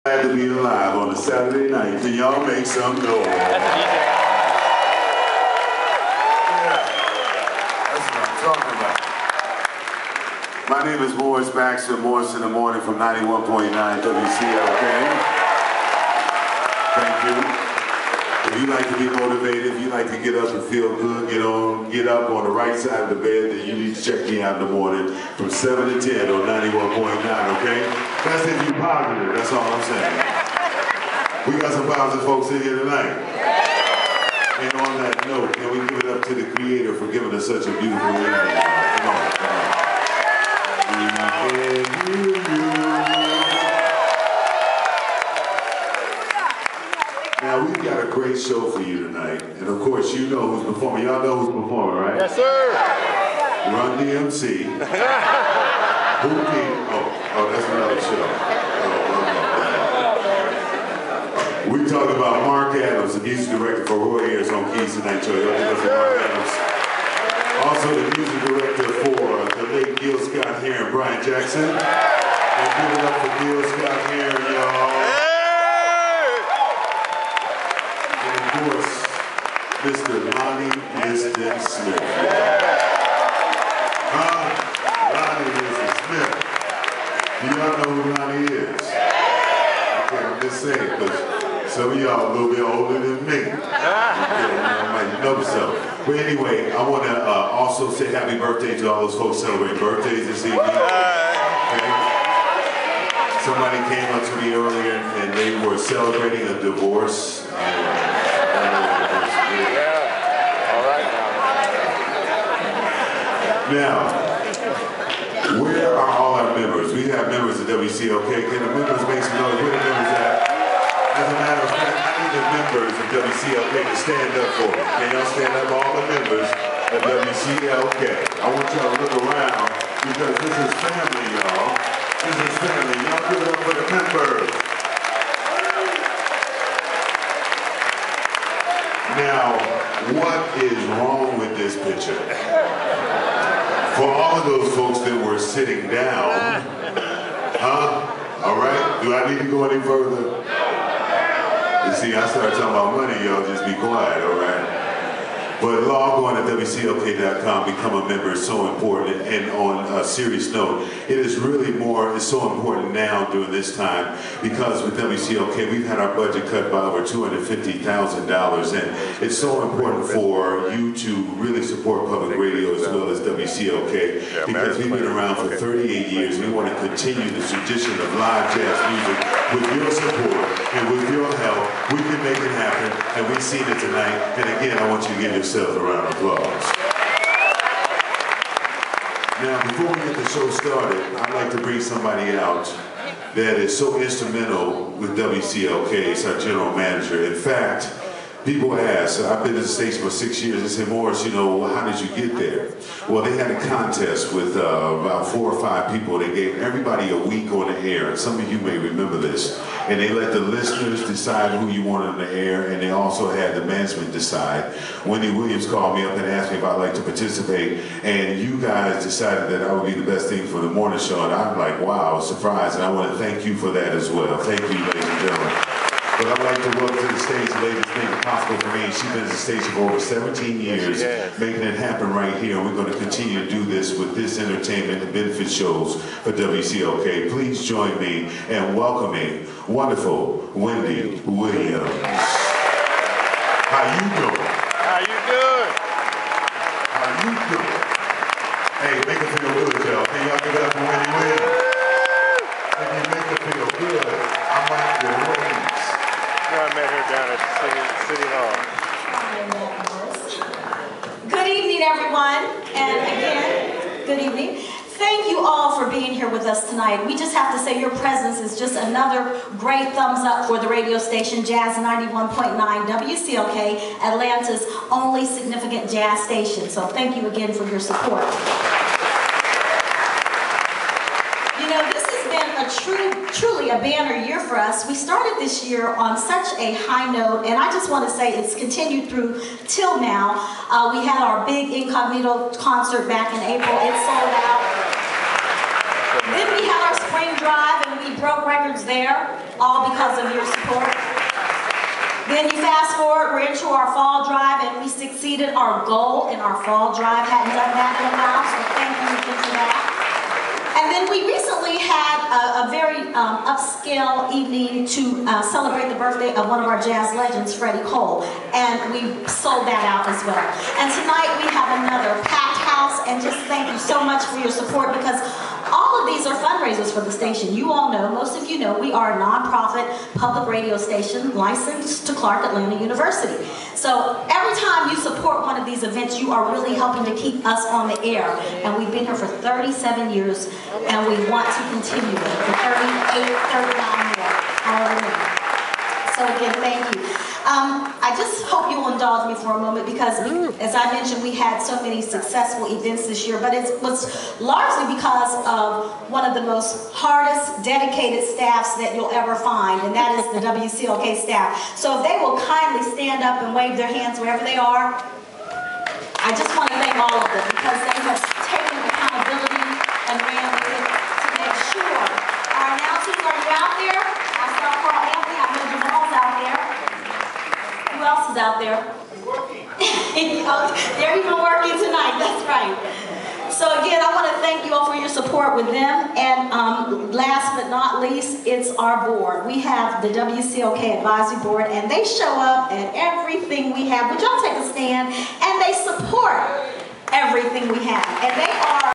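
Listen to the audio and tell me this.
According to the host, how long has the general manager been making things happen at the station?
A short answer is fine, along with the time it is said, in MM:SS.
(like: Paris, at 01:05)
over 17 years, at 03:49.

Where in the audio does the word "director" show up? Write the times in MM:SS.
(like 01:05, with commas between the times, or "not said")
01:03, 01:08.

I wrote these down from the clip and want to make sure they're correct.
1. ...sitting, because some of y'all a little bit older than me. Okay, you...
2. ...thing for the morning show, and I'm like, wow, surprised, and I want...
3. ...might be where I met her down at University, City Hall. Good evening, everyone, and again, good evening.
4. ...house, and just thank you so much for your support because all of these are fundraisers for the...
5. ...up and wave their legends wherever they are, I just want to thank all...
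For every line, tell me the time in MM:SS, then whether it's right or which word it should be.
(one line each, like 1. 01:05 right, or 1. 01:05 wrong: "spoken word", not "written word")
1. 01:30 wrong: "saying", not "sitting"
2. 03:40 right
3. 04:14 wrong: "City", not "University"
4. 05:22 right
5. 06:03 wrong: "hands", not "legends".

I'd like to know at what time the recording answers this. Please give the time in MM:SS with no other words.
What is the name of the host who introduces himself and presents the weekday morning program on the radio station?
00:11.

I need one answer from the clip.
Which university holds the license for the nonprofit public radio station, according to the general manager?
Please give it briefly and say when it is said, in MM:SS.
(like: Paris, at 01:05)
Clark Atlanta University, at 05:32.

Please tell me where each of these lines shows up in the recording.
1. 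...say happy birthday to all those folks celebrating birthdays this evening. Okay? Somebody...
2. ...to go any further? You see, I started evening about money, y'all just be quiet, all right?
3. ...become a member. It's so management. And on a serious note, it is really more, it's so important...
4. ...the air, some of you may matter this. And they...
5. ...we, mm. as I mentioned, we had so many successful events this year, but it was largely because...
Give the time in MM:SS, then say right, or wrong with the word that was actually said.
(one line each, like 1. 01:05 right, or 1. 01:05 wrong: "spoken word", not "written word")
1. 01:37 right
2. 02:29 wrong: "talking", not "evening"
3. 02:37 wrong: "important", not "management"
4. 03:27 wrong: "remember", not "matter"
5. 05:50 right.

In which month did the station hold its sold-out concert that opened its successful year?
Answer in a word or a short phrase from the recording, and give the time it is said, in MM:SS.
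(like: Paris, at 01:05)
April, at 04:53.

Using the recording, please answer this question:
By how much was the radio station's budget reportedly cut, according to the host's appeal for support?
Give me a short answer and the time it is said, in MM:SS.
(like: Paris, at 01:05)
$250,000, at 02:47.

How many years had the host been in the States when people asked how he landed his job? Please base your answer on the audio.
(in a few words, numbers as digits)
6.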